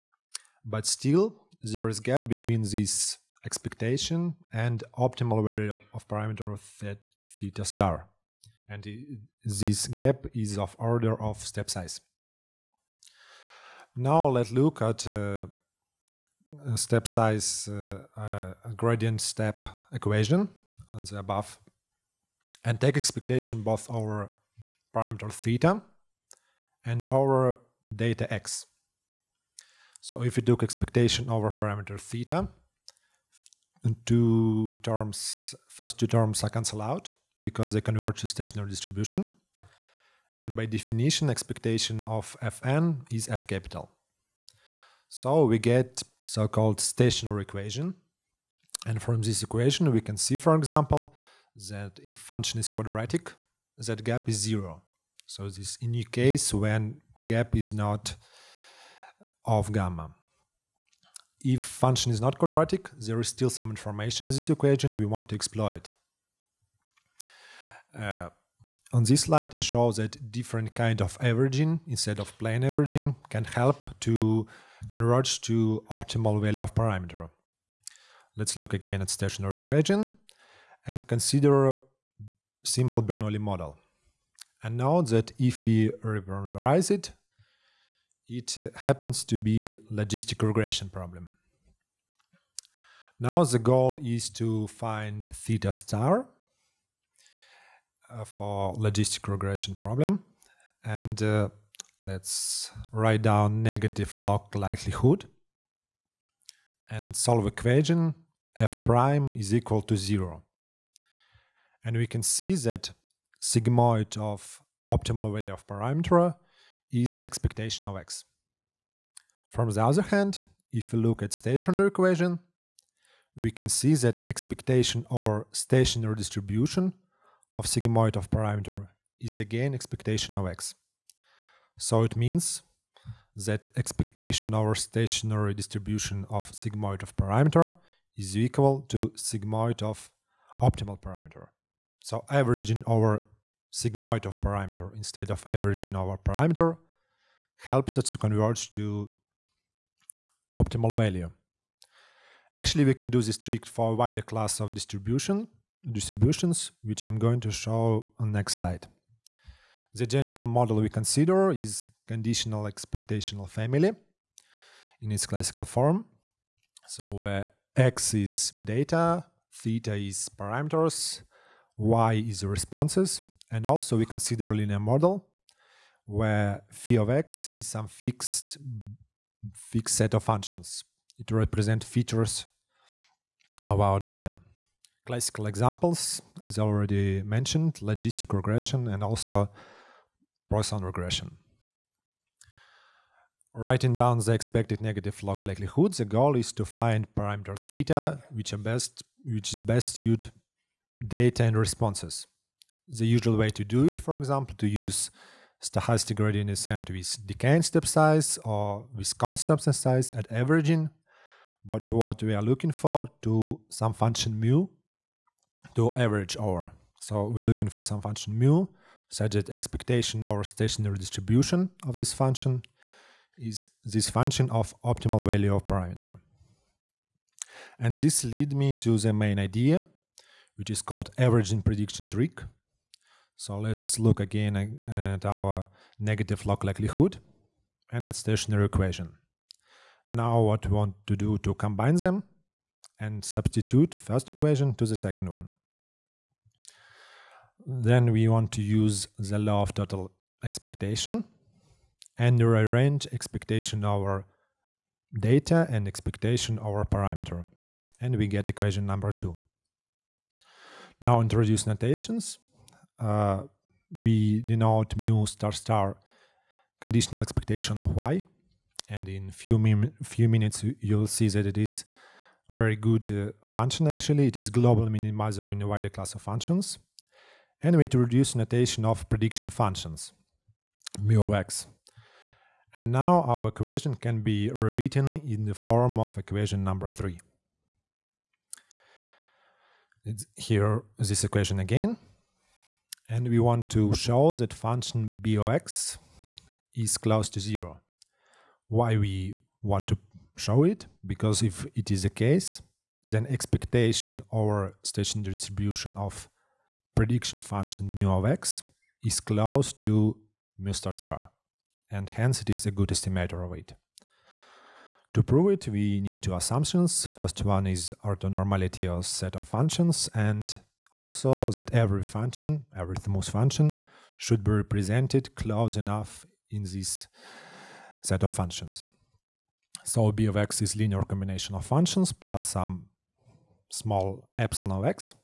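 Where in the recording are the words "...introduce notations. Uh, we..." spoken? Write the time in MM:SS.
04:21.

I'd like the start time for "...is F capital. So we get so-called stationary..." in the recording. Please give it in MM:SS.
00:43.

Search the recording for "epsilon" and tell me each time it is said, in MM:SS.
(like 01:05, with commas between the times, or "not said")
05:34.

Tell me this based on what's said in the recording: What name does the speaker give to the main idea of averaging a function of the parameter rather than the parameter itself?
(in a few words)
Averaging prediction trick.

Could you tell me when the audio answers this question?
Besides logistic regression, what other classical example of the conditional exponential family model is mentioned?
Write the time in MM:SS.
03:10.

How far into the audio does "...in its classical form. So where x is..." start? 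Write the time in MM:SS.
02:45.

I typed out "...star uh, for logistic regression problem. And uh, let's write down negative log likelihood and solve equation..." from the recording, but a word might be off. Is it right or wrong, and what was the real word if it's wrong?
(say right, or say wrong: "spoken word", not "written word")
right.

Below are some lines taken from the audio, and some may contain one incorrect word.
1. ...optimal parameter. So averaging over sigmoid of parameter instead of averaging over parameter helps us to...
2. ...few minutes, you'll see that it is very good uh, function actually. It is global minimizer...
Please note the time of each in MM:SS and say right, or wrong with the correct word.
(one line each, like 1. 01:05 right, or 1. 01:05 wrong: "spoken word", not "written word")
1. 02:20 right
2. 04:30 right.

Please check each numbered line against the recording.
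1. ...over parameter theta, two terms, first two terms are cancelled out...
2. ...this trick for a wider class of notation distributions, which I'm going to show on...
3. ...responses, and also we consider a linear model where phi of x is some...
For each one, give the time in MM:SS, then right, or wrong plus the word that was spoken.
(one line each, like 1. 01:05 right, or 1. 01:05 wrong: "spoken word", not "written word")
1. 00:31 right
2. 02:33 wrong: "distribution", not "notation"
3. 02:52 right.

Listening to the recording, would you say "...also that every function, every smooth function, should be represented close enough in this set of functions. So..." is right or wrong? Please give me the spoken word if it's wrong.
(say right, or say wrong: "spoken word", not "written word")
right.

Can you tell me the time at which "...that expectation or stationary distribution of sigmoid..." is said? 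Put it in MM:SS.
02:03.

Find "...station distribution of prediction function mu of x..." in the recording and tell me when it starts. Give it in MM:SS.
05:04.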